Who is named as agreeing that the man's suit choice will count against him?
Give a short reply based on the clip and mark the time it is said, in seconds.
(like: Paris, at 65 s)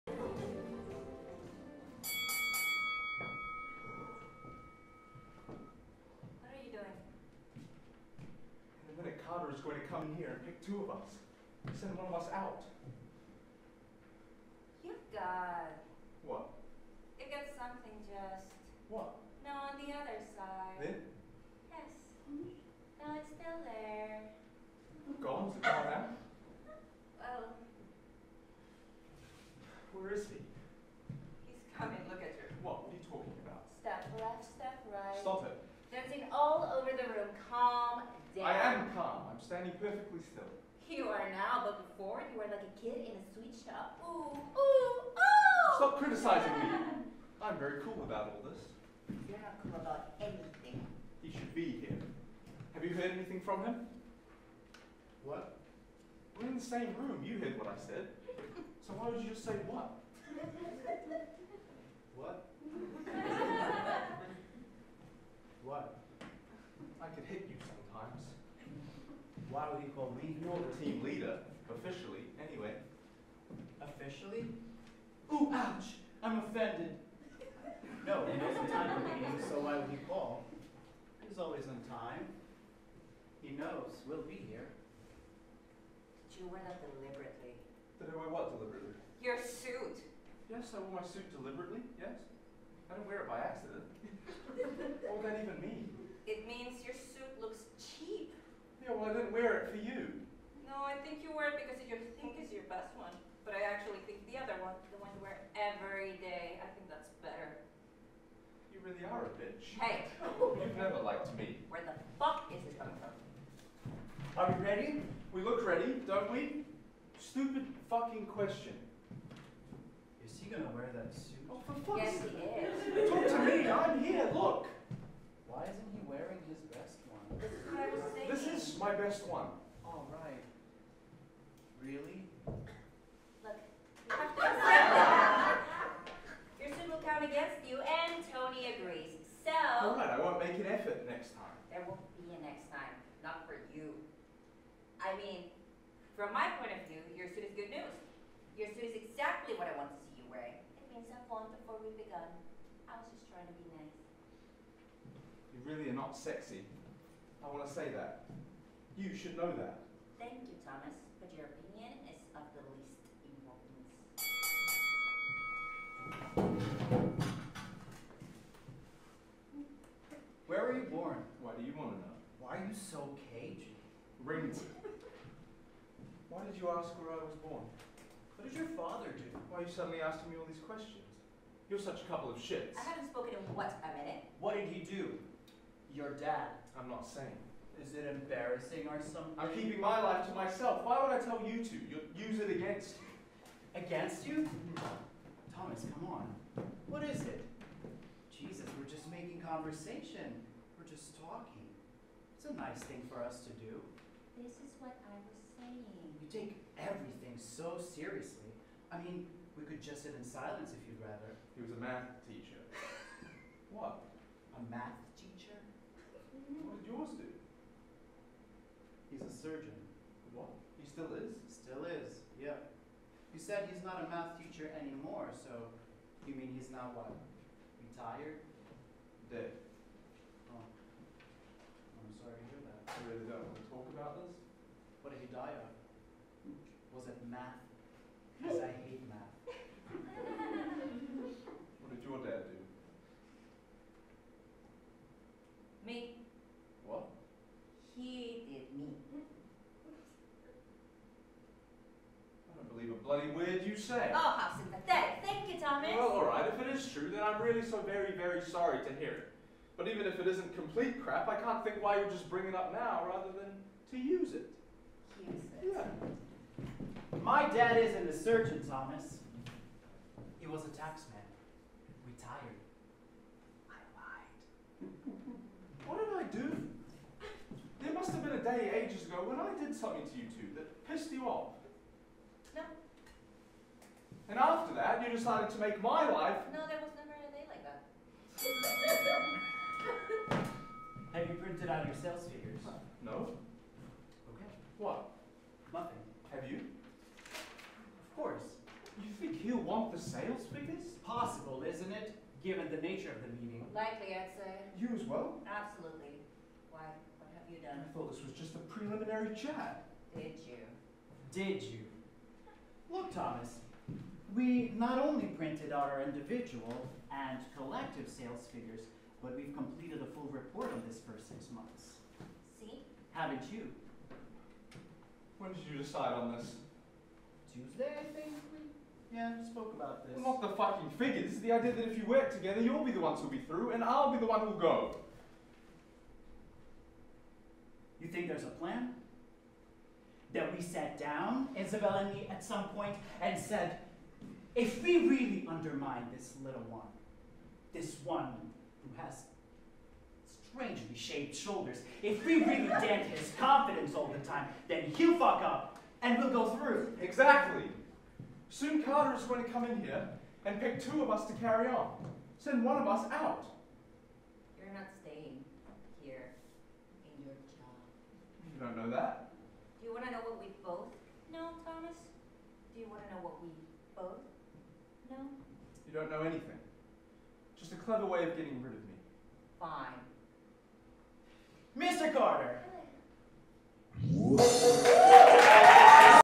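Tony, at 138 s.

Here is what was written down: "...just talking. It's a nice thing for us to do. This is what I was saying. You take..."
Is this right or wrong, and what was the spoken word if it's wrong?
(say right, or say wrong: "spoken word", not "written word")
right.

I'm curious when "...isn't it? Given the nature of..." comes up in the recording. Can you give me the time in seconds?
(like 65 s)
301 s.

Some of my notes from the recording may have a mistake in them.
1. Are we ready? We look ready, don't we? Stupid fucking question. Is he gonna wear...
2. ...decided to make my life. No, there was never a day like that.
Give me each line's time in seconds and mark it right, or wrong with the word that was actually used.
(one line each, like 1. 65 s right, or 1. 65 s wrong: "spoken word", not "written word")
1. 114 s right
2. 285 s right.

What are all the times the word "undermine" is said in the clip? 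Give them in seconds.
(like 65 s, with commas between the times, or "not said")
345 s.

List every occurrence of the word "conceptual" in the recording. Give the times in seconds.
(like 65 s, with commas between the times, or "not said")
not said.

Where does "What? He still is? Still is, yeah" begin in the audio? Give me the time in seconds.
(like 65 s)
220 s.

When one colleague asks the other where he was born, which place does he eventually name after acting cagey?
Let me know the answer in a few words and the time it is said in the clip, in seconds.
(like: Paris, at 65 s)
Ringwood, at 174 s.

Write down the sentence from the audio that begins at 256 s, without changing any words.
If it is true, then I'm really so very, very sorry to hear it.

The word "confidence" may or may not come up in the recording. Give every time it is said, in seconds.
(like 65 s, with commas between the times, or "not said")
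353 s.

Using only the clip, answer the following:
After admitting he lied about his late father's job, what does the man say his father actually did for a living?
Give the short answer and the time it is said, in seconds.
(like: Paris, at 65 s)
Taxman, at 270 s.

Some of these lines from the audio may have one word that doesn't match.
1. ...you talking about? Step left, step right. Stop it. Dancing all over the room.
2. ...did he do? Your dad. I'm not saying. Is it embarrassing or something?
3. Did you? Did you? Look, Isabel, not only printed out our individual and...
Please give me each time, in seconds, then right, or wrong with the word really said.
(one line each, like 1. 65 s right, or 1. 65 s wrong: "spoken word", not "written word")
1. 32 s right
2. 184 s right
3. 310 s wrong: "Thomas", not "Isabel".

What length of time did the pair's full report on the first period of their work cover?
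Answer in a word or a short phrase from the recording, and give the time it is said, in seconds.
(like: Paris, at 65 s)
6 months, at 321 s.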